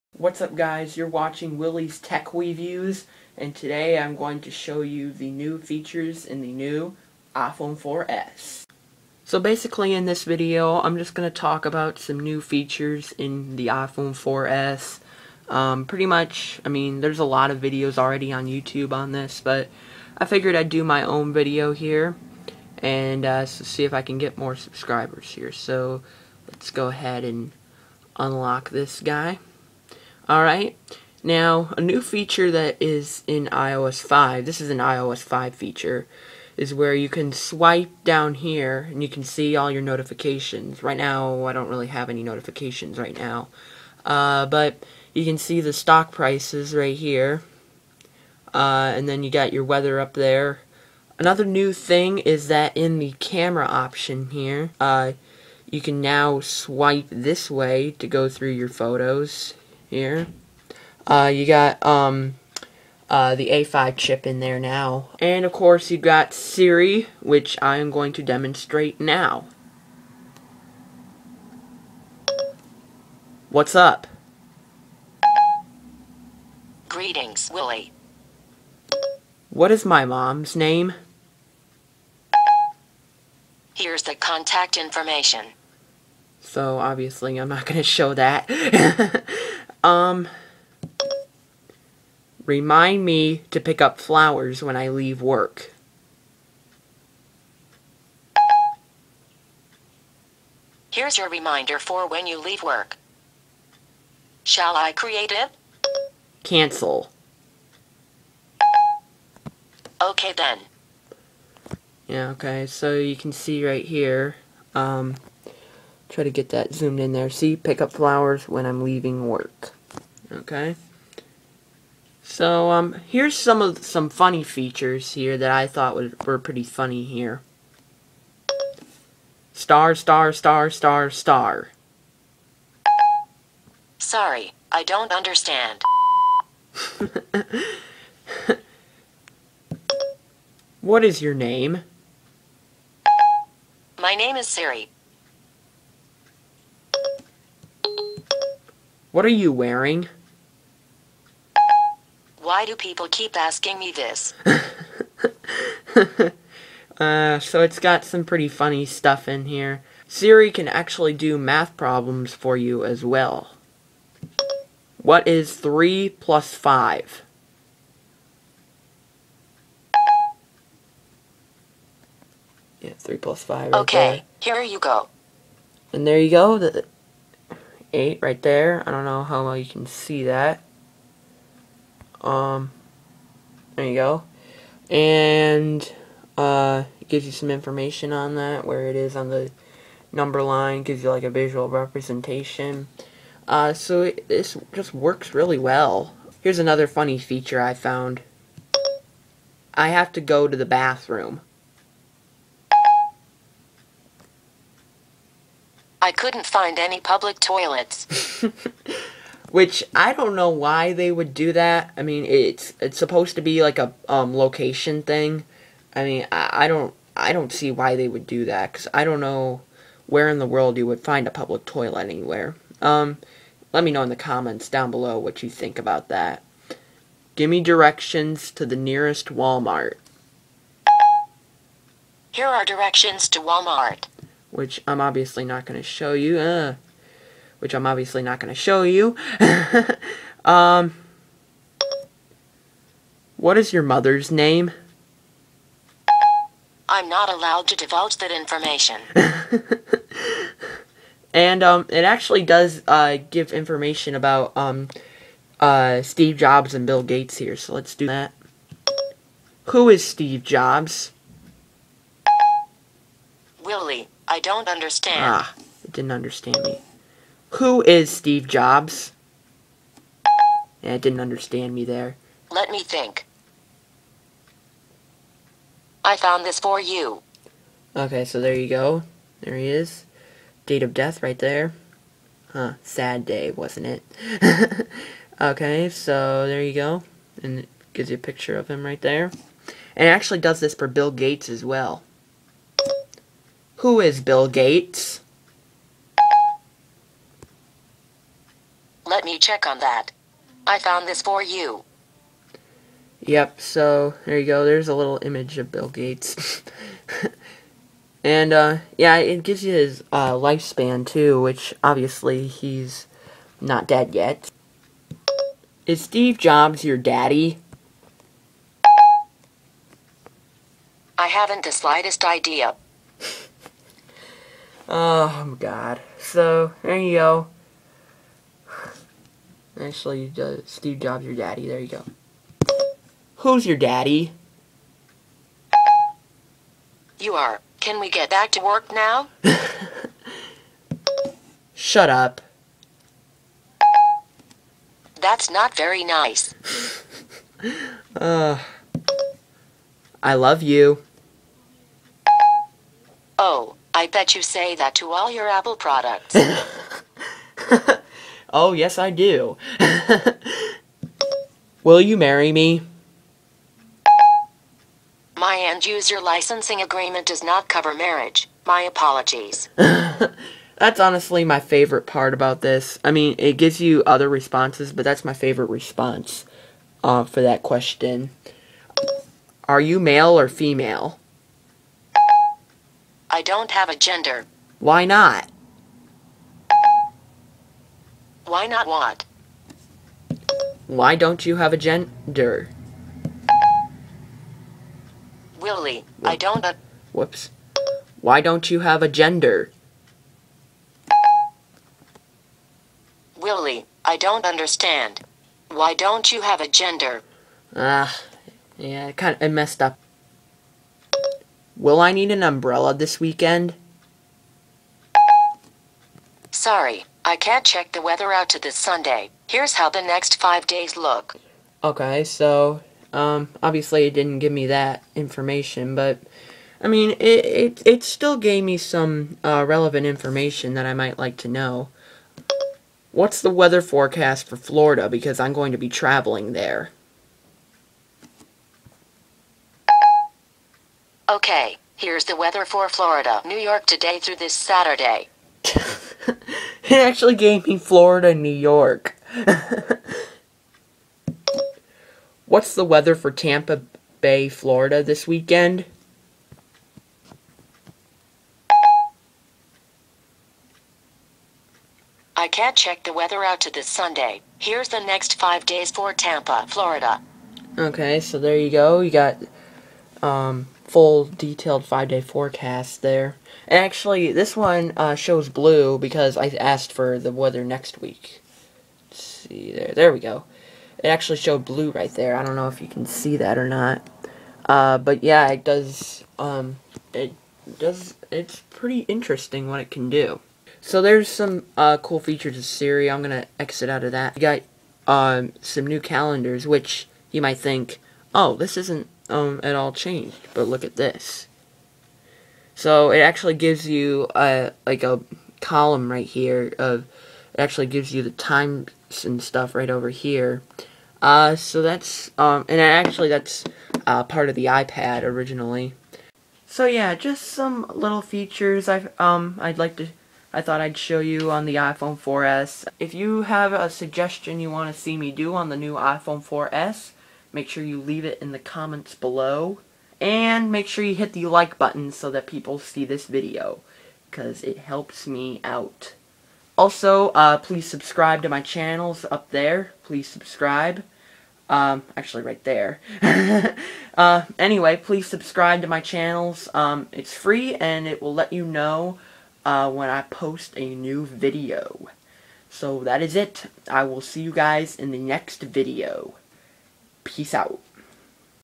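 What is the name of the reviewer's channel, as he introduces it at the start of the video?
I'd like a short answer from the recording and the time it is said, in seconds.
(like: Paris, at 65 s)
Willie's Tech Reviews, at 1 s.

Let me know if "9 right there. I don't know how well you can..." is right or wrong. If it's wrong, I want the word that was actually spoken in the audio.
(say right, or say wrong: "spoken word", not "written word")
wrong: "8", not "9".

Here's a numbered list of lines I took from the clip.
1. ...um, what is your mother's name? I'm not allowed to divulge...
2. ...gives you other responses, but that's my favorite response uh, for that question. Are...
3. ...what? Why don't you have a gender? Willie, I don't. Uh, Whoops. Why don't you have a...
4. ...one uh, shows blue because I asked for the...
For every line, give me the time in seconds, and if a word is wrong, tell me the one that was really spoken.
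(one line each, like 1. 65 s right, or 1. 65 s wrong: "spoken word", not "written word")
1. 240 s right
2. 373 s right
3. 388 s right
4. 474 s right.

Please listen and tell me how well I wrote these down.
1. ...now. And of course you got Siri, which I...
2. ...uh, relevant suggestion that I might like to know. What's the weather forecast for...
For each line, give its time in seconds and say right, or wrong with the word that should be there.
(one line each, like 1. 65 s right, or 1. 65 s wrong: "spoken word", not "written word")
1. 64 s right
2. 429 s wrong: "information", not "suggestion".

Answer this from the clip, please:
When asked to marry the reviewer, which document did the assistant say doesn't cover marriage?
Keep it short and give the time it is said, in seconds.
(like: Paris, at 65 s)
End user licensing agreement, at 365 s.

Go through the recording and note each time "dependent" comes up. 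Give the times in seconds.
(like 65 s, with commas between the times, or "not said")
not said.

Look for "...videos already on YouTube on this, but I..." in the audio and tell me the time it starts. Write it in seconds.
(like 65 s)
17 s.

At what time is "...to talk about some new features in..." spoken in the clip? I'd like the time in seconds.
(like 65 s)
11 s.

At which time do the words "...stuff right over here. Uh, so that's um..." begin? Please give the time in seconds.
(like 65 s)
509 s.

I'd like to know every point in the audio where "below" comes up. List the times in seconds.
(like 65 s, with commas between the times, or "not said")
224 s, 529 s.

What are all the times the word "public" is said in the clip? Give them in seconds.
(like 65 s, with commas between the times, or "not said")
206 s, 221 s.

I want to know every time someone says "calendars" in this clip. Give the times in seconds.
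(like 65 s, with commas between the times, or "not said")
496 s.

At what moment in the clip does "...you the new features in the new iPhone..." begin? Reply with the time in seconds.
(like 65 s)
4 s.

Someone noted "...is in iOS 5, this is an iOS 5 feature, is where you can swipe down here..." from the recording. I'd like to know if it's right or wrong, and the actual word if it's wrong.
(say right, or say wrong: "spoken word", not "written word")
right.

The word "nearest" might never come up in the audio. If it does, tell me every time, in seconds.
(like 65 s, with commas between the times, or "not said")
228 s.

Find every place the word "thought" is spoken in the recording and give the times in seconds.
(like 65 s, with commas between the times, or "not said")
125 s, 520 s.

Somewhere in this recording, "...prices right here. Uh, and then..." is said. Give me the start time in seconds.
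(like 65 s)
46 s.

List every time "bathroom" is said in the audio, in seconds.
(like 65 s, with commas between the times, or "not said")
200 s.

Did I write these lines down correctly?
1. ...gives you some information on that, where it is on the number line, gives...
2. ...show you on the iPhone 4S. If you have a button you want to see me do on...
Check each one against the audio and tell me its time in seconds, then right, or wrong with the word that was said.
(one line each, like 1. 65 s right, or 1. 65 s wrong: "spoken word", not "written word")
1. 187 s right
2. 520 s wrong: "suggestion", not "button".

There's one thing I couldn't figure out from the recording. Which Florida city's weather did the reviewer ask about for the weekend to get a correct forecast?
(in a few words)
Tampa Bay.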